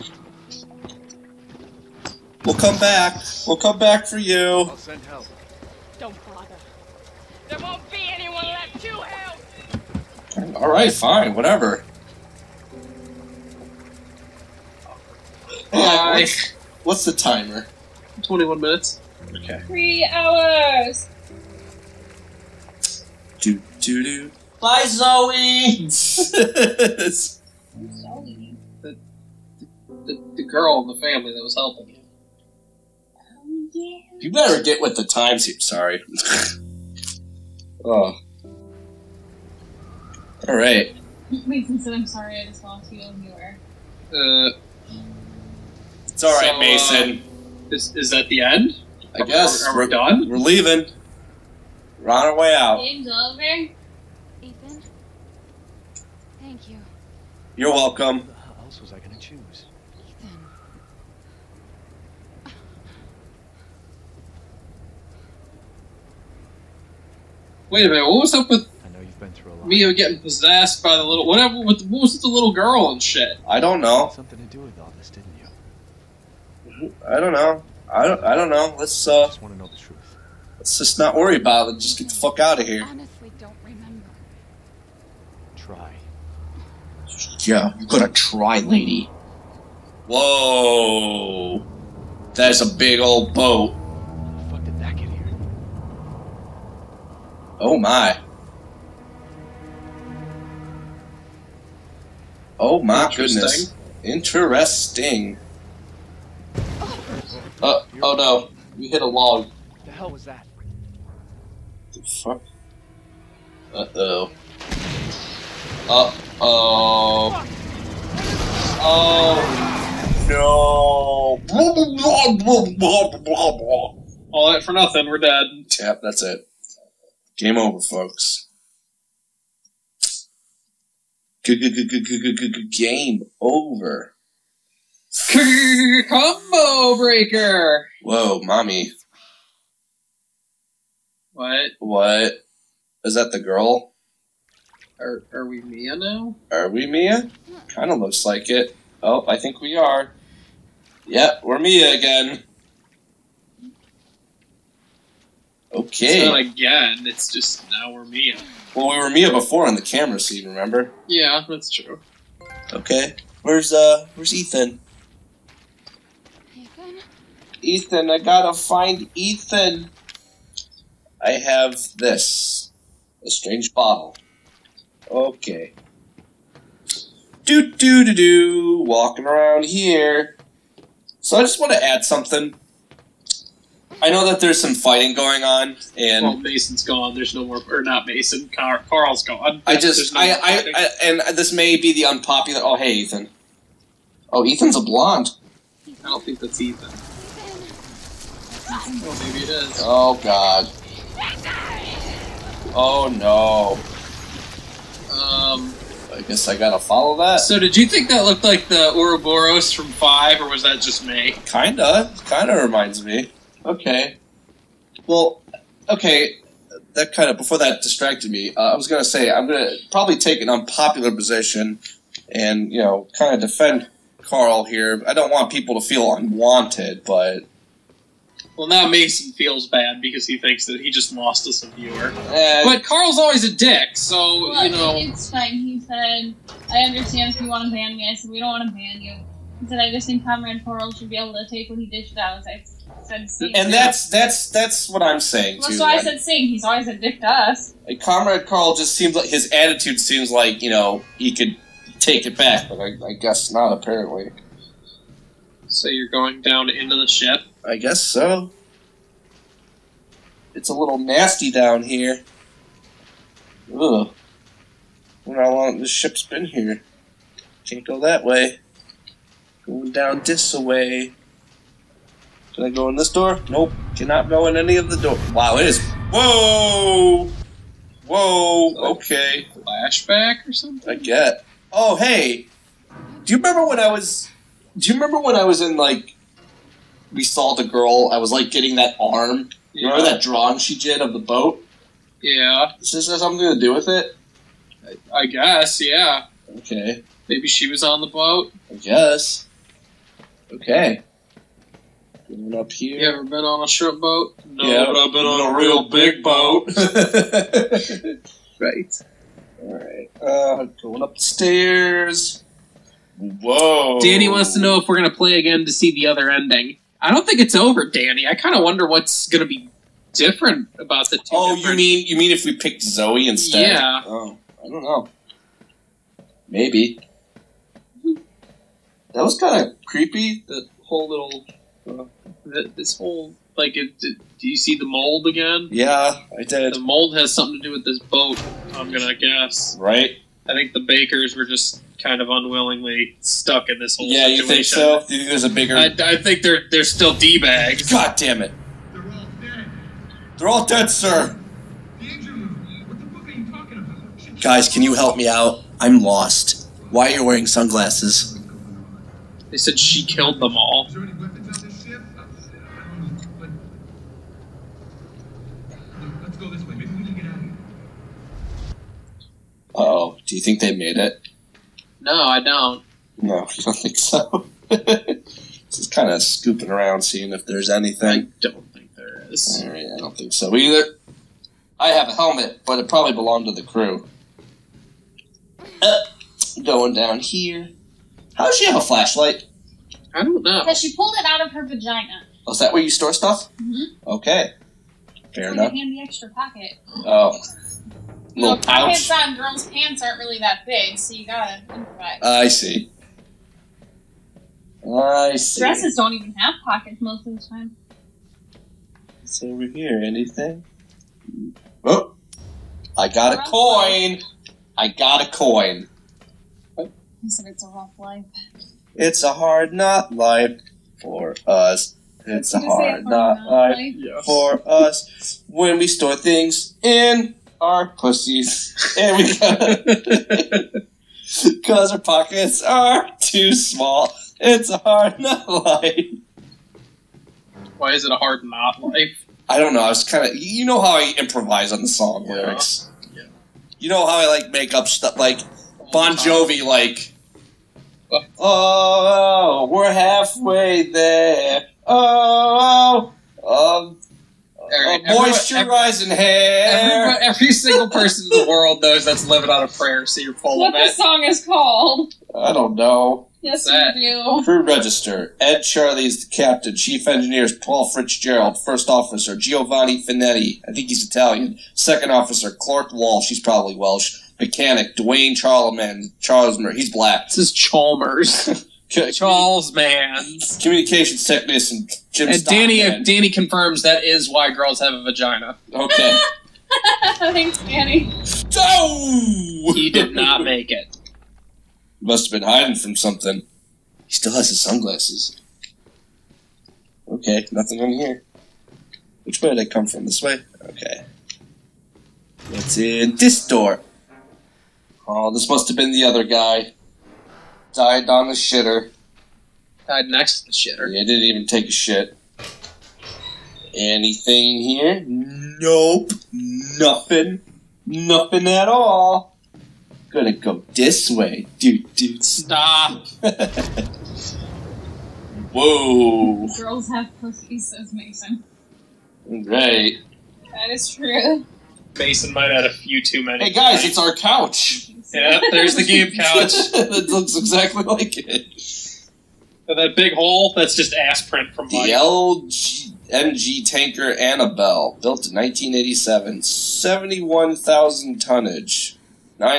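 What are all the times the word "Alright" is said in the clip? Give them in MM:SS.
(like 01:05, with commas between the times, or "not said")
00:10, 05:09.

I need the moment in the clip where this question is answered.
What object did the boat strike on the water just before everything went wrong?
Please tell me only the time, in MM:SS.
01:49.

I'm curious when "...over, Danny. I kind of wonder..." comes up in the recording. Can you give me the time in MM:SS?
05:17.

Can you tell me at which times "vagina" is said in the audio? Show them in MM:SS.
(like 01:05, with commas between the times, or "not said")
06:31, 08:05.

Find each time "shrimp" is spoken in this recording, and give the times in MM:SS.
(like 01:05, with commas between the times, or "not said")
05:03.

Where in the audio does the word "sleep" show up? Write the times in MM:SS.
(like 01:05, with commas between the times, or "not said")
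not said.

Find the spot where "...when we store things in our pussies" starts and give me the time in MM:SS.
07:05.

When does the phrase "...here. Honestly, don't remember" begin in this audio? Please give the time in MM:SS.
01:22.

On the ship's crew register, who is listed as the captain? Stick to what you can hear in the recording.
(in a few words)
Ed Charlie.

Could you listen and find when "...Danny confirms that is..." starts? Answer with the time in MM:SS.
08:03.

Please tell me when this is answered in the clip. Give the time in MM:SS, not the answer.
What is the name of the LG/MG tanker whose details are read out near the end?
09:04.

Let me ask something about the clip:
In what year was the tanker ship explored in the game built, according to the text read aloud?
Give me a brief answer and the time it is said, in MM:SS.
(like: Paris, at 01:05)
1987, at 09:05.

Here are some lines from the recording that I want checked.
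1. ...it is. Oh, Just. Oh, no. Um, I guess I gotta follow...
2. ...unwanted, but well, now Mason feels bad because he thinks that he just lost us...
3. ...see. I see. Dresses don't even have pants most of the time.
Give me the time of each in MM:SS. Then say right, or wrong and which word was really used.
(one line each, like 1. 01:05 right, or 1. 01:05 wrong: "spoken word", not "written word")
1. 03:19 wrong: "God", not "Just"
2. 03:46 right
3. 06:42 wrong: "pockets", not "pants".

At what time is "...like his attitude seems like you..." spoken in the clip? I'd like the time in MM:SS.
04:09.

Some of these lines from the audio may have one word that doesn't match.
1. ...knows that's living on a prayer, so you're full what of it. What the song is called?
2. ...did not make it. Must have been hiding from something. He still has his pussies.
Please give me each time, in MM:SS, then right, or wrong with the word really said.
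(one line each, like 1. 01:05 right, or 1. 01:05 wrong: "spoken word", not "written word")
1. 07:38 right
2. 08:09 wrong: "sunglasses", not "pussies".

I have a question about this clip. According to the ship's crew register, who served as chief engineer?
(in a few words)
Paul Fitzgerald.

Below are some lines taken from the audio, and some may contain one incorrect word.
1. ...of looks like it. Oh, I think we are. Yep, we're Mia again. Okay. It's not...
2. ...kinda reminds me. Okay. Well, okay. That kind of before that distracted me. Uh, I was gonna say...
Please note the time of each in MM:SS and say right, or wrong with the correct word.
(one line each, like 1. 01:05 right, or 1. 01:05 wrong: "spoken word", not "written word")
1. 02:27 right
2. 03:32 right.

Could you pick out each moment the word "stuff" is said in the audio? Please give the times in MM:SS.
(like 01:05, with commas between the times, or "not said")
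06:33, 07:24.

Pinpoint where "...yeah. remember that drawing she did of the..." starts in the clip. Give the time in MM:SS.
04:49.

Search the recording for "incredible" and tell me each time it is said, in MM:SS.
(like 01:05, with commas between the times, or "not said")
not said.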